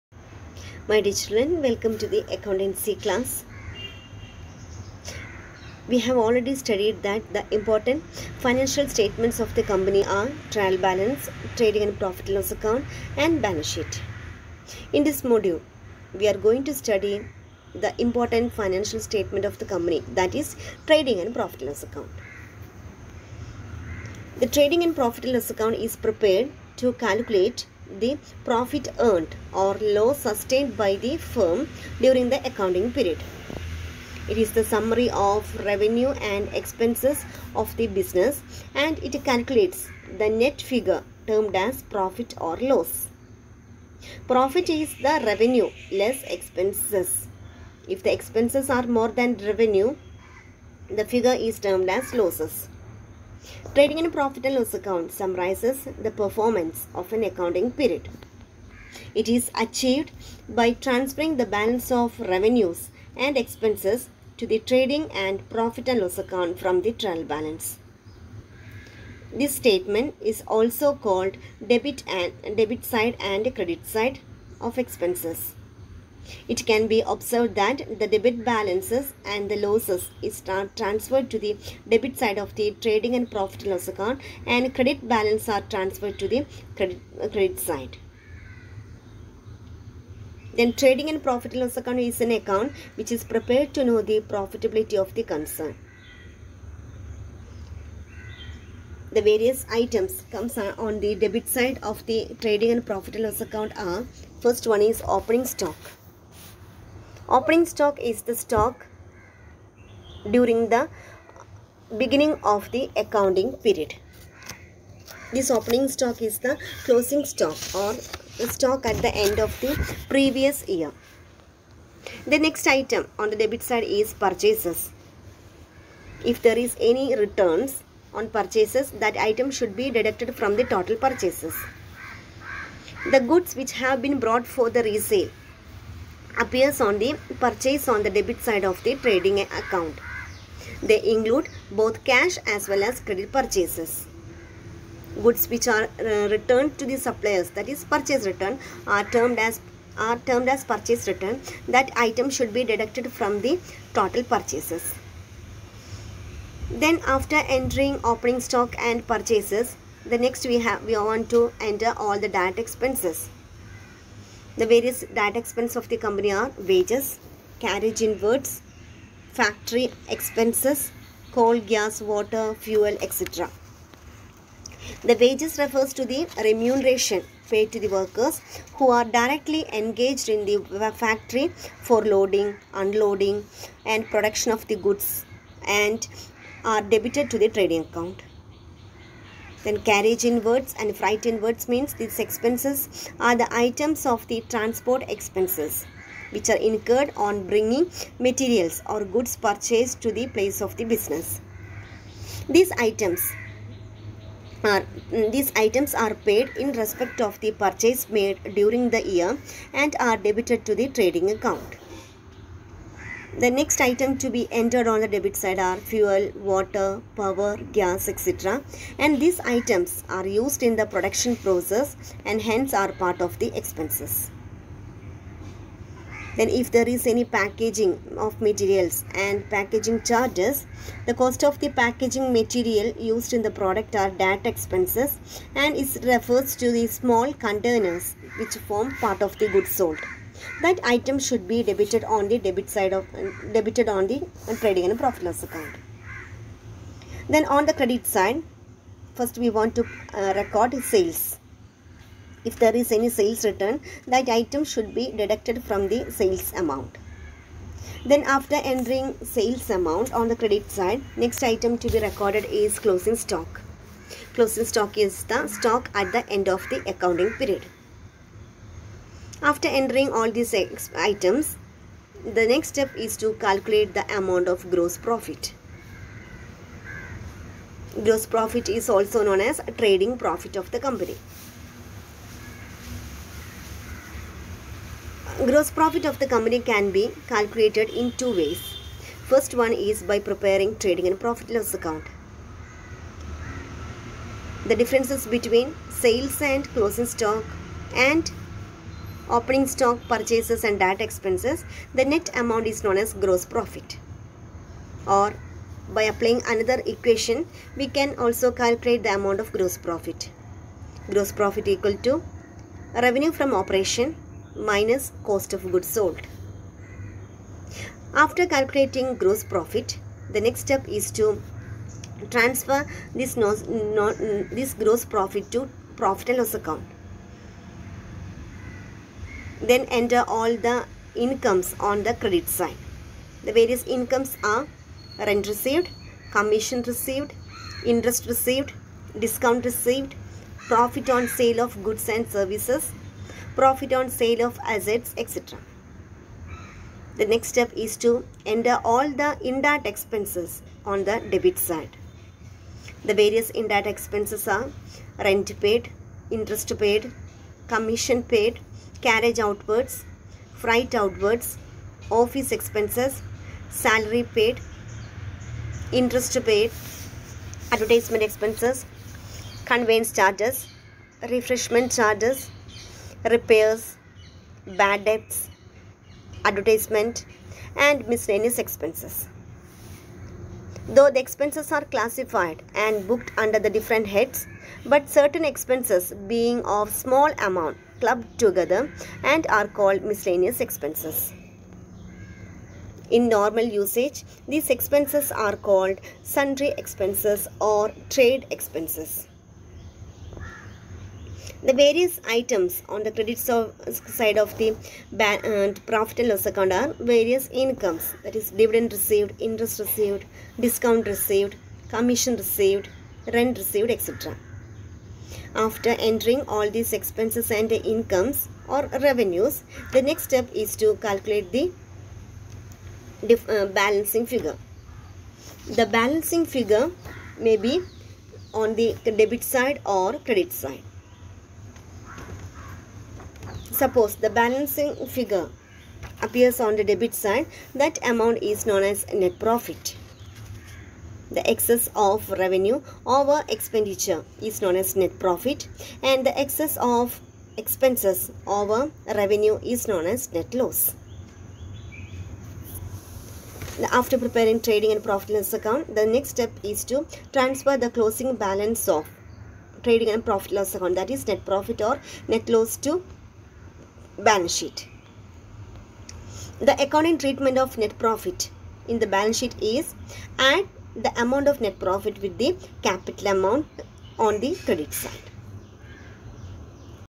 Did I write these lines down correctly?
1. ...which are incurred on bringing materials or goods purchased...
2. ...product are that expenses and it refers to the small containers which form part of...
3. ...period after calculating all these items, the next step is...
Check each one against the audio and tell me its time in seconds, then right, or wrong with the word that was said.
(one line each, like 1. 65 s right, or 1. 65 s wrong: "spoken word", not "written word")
1. 196 s right
2. 233 s right
3. 267 s wrong: "entering", not "calculating".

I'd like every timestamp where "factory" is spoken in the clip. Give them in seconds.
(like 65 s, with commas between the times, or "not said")
169 s, 180 s.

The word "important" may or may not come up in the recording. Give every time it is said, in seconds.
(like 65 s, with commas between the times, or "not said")
7 s, 18 s.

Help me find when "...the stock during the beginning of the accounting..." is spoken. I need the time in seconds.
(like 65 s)
108 s.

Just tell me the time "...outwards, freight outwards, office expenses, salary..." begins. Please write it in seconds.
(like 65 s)
359 s.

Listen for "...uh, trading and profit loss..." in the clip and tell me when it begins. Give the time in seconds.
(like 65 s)
244 s.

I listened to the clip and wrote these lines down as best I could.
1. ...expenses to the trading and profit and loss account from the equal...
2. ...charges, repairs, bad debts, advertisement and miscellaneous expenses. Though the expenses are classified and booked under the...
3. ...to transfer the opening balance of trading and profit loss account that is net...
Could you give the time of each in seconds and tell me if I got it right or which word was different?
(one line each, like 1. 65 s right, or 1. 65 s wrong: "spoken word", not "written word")
1. 63 s wrong: "trial", not "equal"
2. 371 s right
3. 456 s wrong: "closing", not "opening".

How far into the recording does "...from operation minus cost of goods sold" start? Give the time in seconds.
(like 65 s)
313 s.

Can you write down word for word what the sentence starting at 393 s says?
In normal usage, these expenses are called sundry expenses or trade expenses.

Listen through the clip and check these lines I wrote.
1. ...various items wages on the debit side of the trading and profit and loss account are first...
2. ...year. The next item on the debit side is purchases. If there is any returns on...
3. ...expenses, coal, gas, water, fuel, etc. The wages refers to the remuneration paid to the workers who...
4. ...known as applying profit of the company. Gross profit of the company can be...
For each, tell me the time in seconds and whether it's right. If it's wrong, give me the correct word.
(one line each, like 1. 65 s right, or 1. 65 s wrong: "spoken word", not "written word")
1. 99 s wrong: "comes", not "wages"
2. 120 s right
3. 170 s right
4. 279 s wrong: "trading", not "applying".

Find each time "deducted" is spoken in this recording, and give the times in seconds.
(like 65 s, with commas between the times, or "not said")
129 s, 152 s, 255 s.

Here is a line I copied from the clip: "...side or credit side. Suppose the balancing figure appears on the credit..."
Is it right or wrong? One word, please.
wrong.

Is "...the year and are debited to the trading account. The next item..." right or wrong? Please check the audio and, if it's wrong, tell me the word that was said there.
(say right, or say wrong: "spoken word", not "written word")
right.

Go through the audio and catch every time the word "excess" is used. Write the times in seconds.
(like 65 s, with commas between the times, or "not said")
441 s, 446 s.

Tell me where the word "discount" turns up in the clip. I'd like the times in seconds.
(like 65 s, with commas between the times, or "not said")
339 s, 410 s.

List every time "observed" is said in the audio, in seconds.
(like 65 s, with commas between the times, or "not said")
77 s.